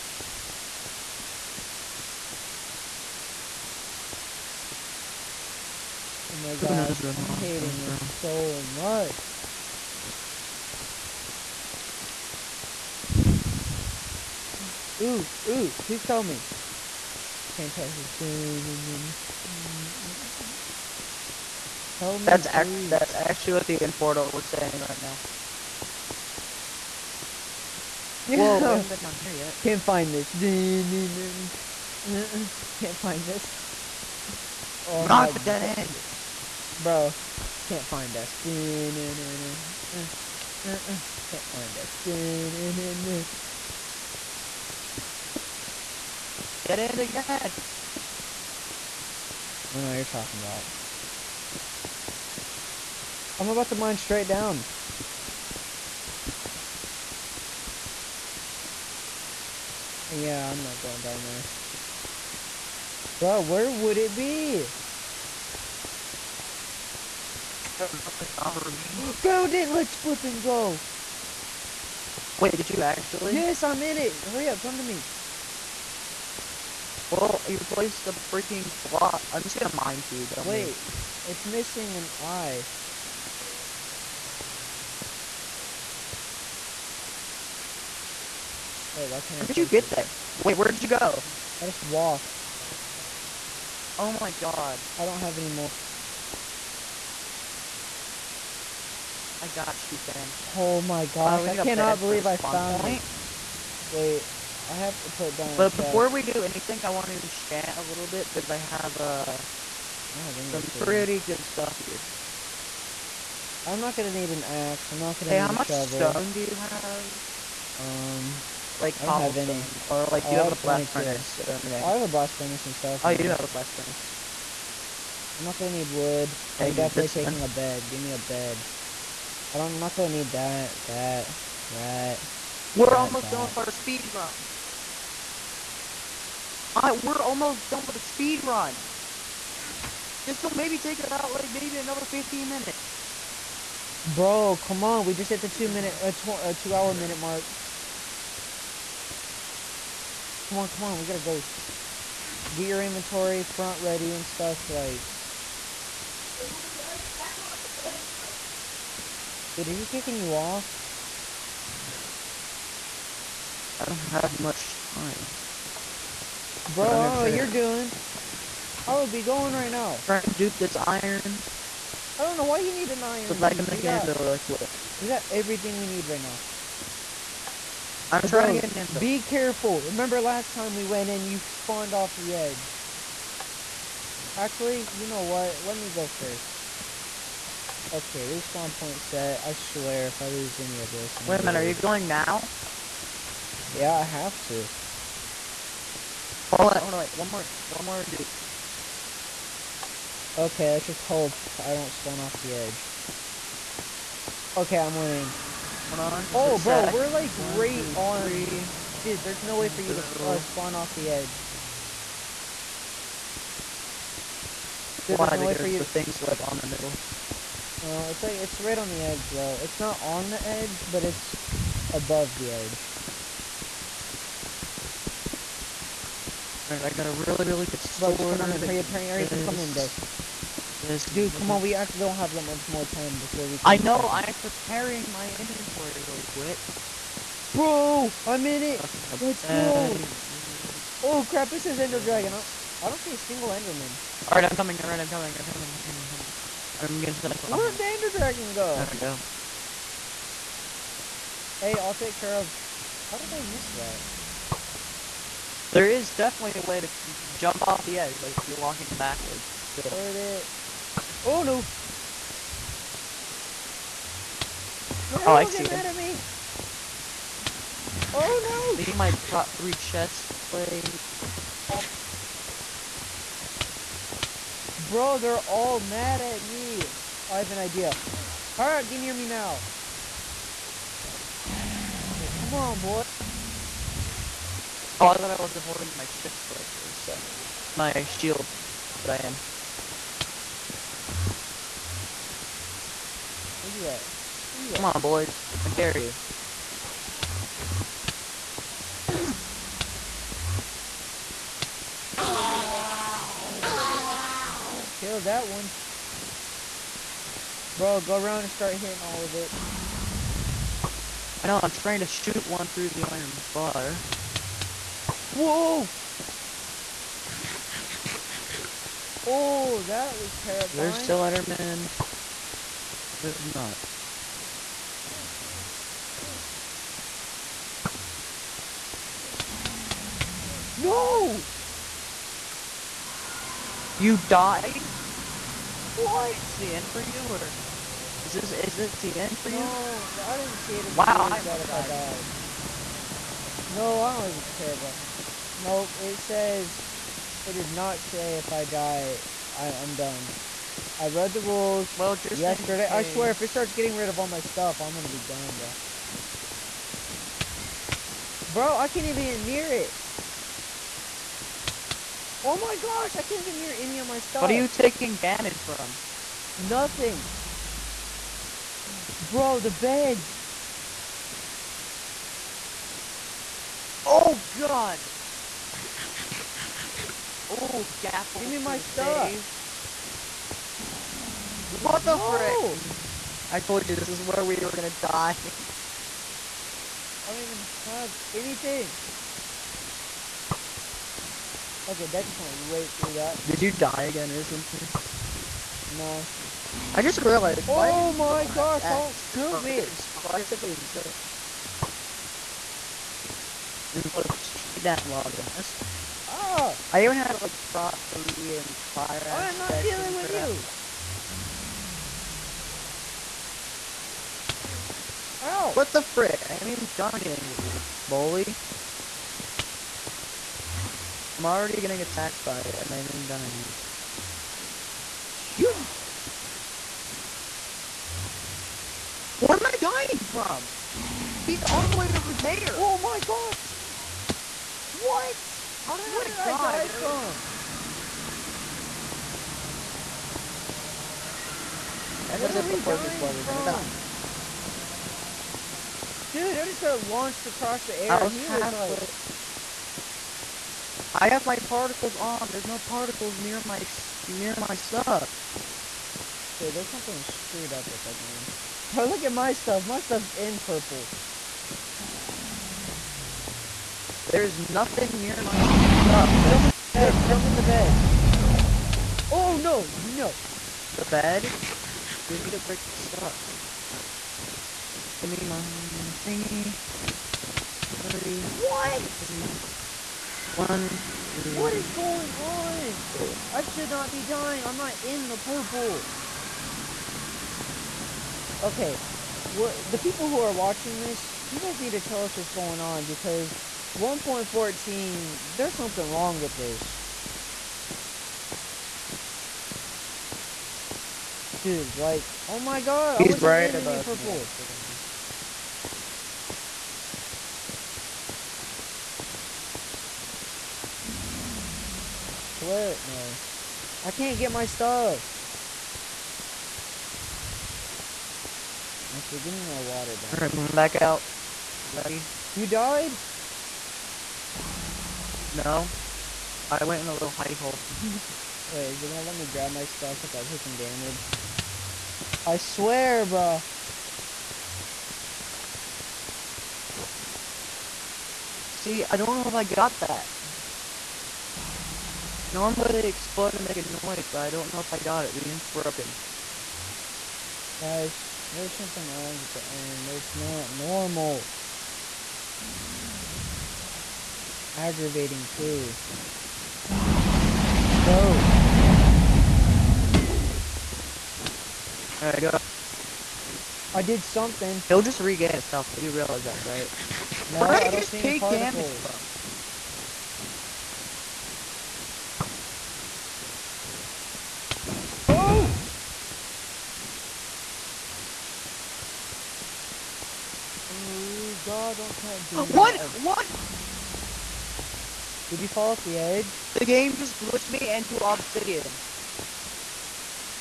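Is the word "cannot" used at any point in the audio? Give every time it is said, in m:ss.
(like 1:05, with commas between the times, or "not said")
1:41.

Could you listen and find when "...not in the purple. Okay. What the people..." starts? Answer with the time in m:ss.
8:04.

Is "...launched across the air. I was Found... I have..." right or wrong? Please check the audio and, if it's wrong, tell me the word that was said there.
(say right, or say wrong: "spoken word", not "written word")
wrong: "Like", not "Found".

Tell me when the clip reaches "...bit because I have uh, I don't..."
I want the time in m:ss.
1:48.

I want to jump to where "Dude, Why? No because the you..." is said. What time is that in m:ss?
3:35.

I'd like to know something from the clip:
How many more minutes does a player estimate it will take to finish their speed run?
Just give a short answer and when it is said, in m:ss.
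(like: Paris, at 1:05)
15, at 2:21.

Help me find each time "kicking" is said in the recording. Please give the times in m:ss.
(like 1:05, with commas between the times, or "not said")
2:39.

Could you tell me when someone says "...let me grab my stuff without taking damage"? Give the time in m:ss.
8:49.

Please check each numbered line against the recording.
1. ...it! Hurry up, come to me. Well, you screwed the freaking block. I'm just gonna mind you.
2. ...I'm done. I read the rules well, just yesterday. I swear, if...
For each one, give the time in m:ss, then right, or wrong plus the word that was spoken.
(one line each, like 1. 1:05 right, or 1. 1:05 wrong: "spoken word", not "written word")
1. 1:13 wrong: "placed", not "screwed"
2. 5:49 right.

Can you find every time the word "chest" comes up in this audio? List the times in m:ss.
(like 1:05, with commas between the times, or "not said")
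4:29, 4:46.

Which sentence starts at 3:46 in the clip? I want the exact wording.
Alright, I got a really, really good sword.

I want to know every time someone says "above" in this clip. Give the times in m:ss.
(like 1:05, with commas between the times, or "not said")
3:41, 8:23.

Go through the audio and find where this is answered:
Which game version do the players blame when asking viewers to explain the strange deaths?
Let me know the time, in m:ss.
8:13.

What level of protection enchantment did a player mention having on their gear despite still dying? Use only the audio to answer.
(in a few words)
Prot 3.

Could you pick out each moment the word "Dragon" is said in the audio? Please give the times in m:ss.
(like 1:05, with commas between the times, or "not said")
4:02, 4:08.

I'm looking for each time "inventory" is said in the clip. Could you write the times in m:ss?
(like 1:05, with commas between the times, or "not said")
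2:32, 3:55.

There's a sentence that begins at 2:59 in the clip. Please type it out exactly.
Remember last time we went in, you spawned off the edge.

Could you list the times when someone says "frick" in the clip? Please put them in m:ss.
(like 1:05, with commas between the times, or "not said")
6:22, 6:56.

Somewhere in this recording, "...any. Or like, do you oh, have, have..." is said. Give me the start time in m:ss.
1:59.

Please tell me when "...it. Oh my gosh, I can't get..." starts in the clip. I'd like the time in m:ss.
5:59.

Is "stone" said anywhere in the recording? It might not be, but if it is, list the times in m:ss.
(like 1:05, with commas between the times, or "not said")
1:56.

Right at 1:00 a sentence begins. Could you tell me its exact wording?
Yeah, I'm not going down there.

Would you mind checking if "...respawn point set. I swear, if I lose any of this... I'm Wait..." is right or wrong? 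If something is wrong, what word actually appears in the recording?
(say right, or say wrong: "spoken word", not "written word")
right.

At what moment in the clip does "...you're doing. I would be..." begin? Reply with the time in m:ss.
2:47.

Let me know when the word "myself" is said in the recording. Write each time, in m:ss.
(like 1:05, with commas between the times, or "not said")
4:07.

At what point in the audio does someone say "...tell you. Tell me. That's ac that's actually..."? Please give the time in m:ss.
0:17.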